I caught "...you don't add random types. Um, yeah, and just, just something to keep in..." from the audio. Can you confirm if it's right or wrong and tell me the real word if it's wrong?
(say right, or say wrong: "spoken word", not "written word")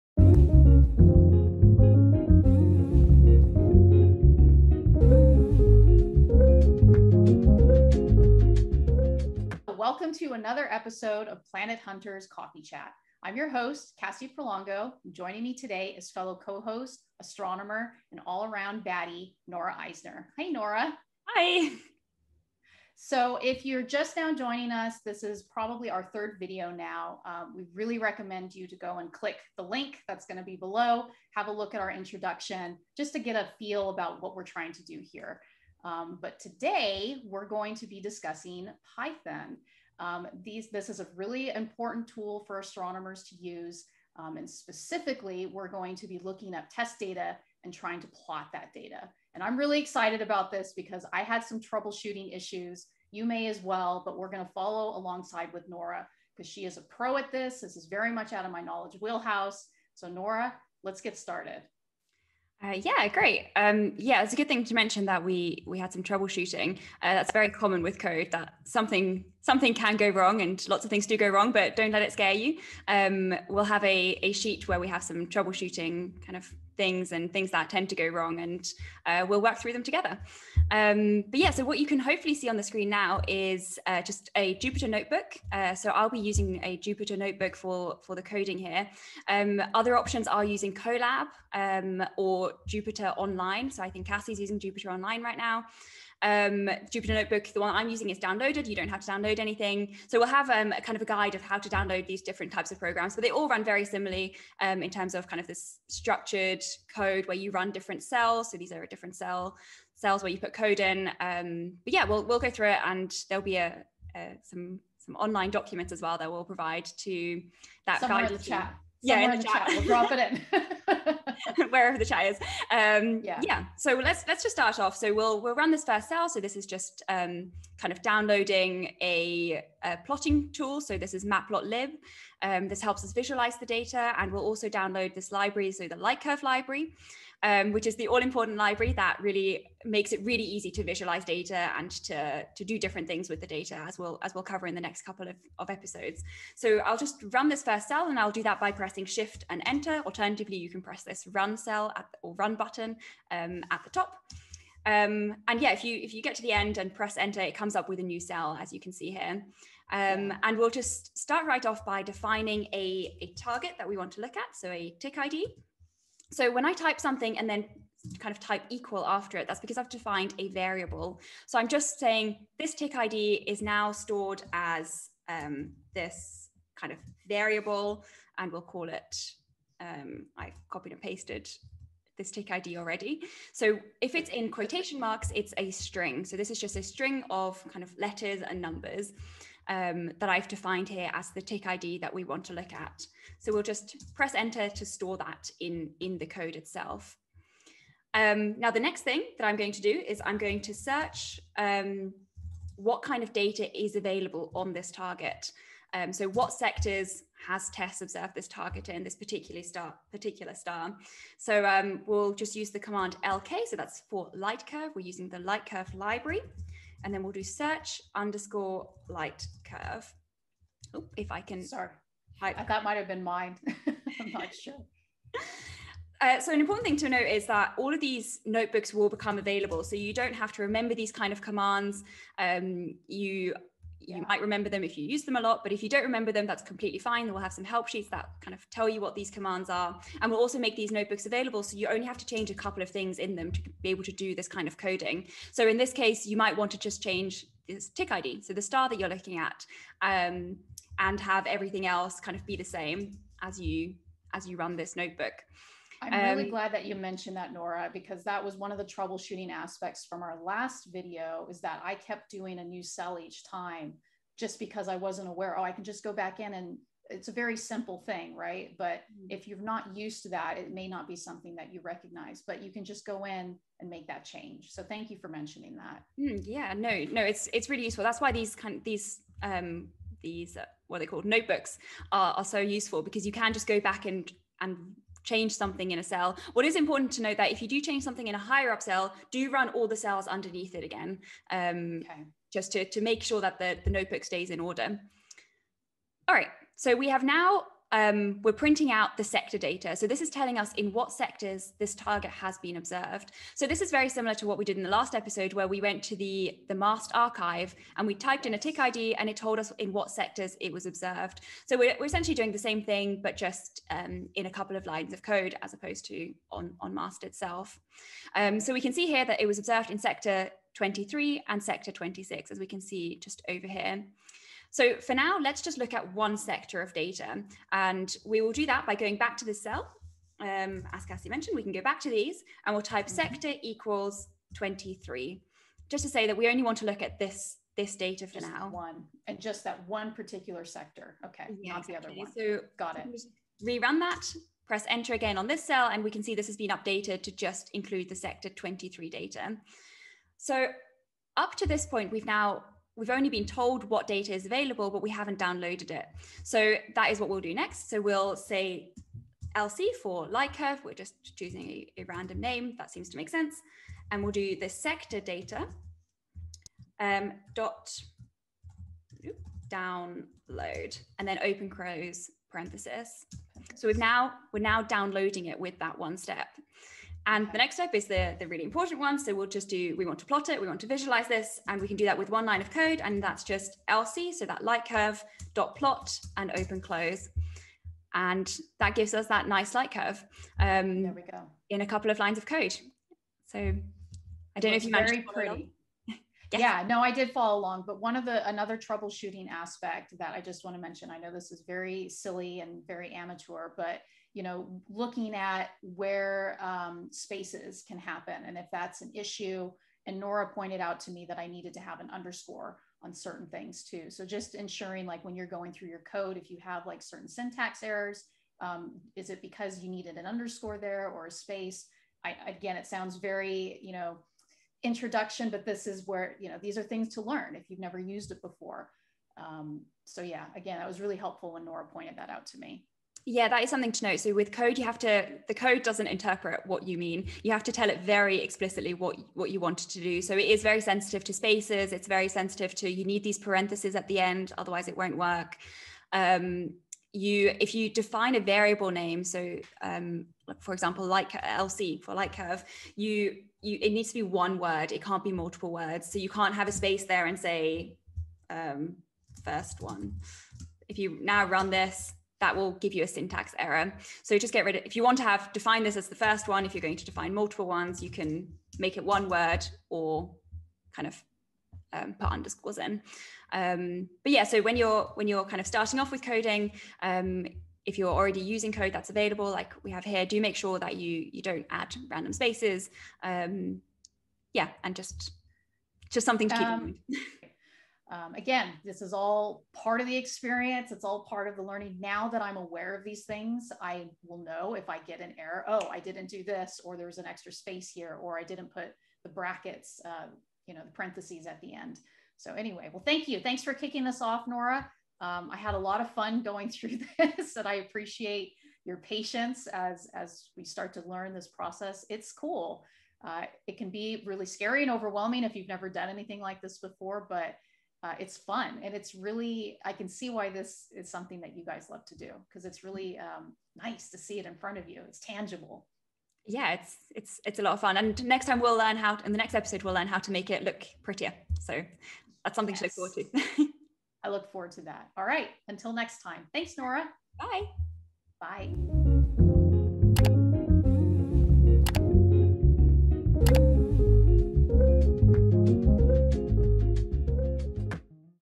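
wrong: "spaces", not "types".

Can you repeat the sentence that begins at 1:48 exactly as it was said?
So these are a different cell cells where you put code in.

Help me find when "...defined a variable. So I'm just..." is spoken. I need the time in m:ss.
2:49.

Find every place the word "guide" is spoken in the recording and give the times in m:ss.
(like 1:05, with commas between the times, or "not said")
1:41, 1:58.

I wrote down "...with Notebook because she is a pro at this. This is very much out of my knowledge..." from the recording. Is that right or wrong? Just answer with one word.
wrong.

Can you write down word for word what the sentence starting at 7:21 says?
It's very sensitive to you need these parentheses at the end, otherwise it won't work.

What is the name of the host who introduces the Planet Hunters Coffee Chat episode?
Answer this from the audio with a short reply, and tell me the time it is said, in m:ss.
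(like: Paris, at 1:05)
Kassie Prolongo, at 0:14.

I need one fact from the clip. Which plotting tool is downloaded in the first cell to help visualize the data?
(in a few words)
matplotlib.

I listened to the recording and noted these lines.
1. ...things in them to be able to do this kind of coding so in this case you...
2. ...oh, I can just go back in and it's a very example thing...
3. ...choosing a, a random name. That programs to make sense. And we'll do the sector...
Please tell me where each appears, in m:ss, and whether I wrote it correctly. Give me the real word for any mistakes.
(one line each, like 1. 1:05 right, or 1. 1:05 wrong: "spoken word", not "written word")
1. 4:02 right
2. 4:25 wrong: "simple", not "example"
3. 6:01 wrong: "seems", not "programs".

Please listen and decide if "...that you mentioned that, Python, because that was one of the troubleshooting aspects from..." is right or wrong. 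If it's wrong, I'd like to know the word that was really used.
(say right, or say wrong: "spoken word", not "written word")
wrong: "Nora", not "Python".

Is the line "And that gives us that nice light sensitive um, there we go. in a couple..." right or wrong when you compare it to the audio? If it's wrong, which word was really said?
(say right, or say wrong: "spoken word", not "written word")
wrong: "curve", not "sensitive".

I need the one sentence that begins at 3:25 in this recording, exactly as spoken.
Um, so what sectors has TESS observed this target in this particular star?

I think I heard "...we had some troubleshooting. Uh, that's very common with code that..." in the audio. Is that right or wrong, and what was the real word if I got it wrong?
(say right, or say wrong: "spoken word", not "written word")
right.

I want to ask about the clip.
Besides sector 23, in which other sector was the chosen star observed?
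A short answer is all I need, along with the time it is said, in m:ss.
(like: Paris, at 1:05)
26, at 5:21.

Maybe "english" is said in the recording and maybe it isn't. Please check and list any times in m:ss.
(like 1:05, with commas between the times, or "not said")
not said.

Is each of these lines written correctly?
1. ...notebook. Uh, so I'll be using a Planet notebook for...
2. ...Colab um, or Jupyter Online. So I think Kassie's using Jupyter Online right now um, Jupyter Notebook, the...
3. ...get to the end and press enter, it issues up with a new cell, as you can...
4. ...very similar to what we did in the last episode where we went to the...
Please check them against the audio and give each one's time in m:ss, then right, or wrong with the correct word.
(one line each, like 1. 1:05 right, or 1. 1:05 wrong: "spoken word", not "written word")
1. 1:24 wrong: "Jupyter", not "Planet"
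2. 1:30 right
3. 2:36 wrong: "comes", not "issues"
4. 5:03 right.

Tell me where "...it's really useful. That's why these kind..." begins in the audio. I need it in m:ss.
4:37.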